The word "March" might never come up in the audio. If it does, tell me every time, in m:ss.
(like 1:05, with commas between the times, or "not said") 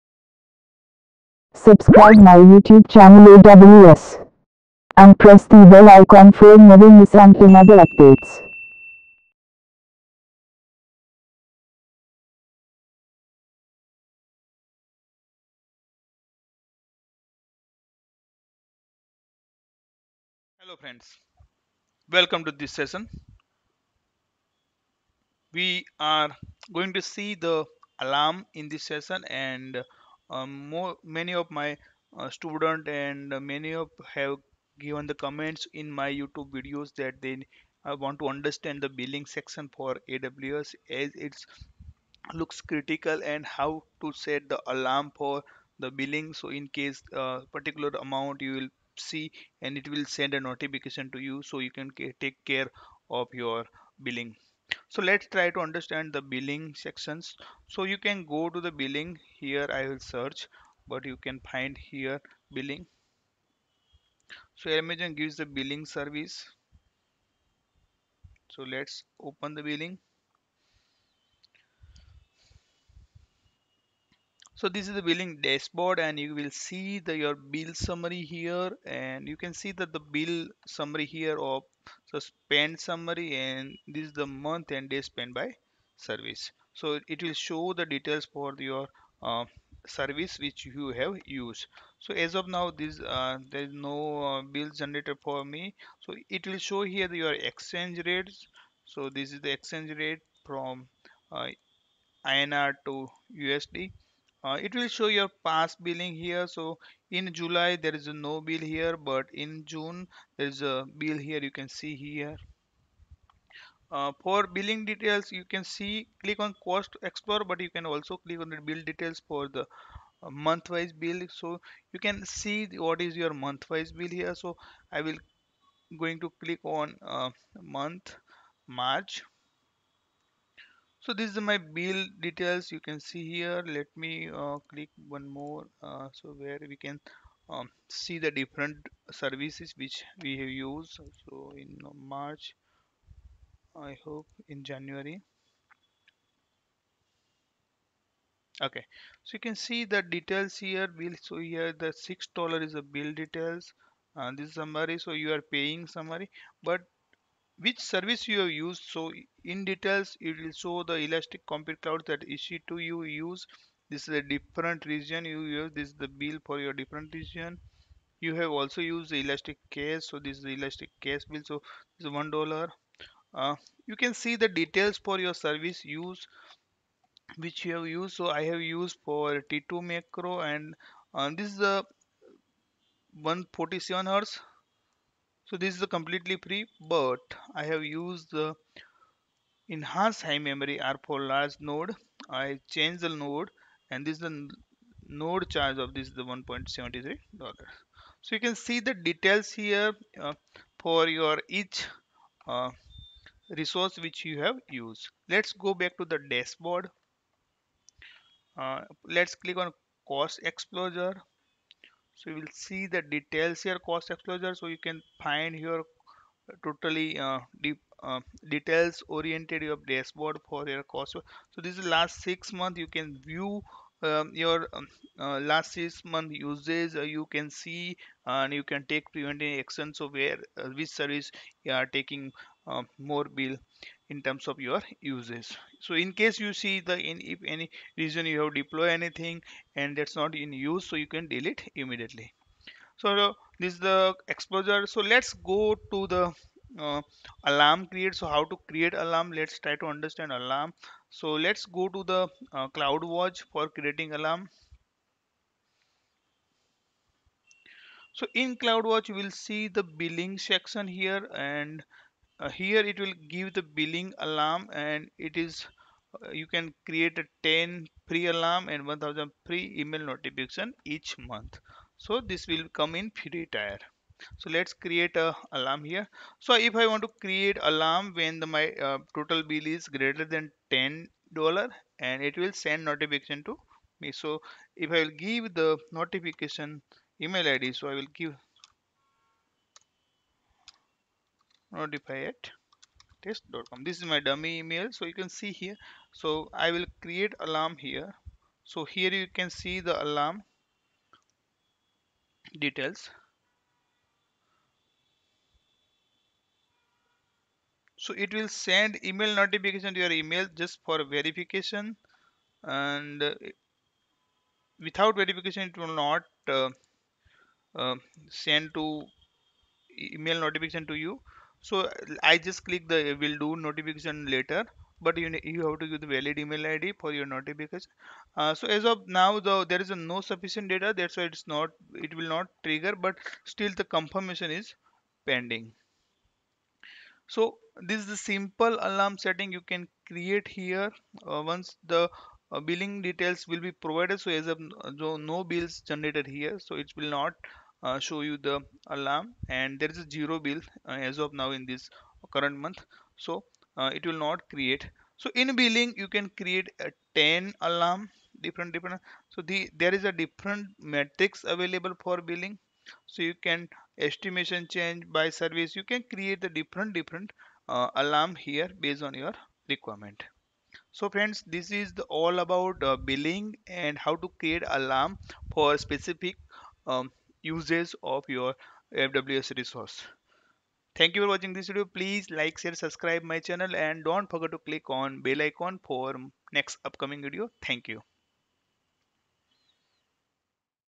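2:08, 2:21.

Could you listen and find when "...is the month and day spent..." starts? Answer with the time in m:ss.
1:24.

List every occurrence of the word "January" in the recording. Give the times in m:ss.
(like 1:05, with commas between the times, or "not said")
2:24.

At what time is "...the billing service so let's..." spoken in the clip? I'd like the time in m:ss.
1:05.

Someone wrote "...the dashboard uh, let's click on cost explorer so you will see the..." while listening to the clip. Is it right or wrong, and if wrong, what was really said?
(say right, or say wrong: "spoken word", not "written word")
right.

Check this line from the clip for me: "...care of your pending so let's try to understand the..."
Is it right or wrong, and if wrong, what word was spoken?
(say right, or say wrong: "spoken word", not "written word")
wrong: "billing", not "pending".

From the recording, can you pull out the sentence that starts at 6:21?
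Please like, share, subscribe my channel and don't forget to click on bell icon for next upcoming video.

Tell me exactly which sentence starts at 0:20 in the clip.
Hello friends, welcome to this session.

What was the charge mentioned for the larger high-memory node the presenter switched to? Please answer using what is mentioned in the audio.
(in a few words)
1.73 dollars.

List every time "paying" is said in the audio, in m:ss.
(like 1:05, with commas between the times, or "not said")
2:35.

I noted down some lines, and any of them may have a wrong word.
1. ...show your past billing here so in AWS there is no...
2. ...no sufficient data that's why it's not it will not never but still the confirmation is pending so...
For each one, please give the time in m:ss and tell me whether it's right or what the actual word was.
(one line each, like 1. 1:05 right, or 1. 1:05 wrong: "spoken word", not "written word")
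1. 1:44 wrong: "July", not "AWS"
2. 5:30 wrong: "trigger", not "never".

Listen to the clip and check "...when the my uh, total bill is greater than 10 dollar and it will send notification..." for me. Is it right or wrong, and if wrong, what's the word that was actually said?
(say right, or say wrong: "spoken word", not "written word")
right.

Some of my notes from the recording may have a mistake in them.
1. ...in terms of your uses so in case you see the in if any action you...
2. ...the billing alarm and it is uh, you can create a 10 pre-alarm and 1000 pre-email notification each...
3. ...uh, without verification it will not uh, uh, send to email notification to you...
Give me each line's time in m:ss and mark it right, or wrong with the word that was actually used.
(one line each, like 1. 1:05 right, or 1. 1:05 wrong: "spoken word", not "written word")
1. 3:54 wrong: "reason", not "action"
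2. 4:23 right
3. 5:13 right.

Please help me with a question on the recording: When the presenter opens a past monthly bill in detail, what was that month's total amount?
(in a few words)
6 dollars.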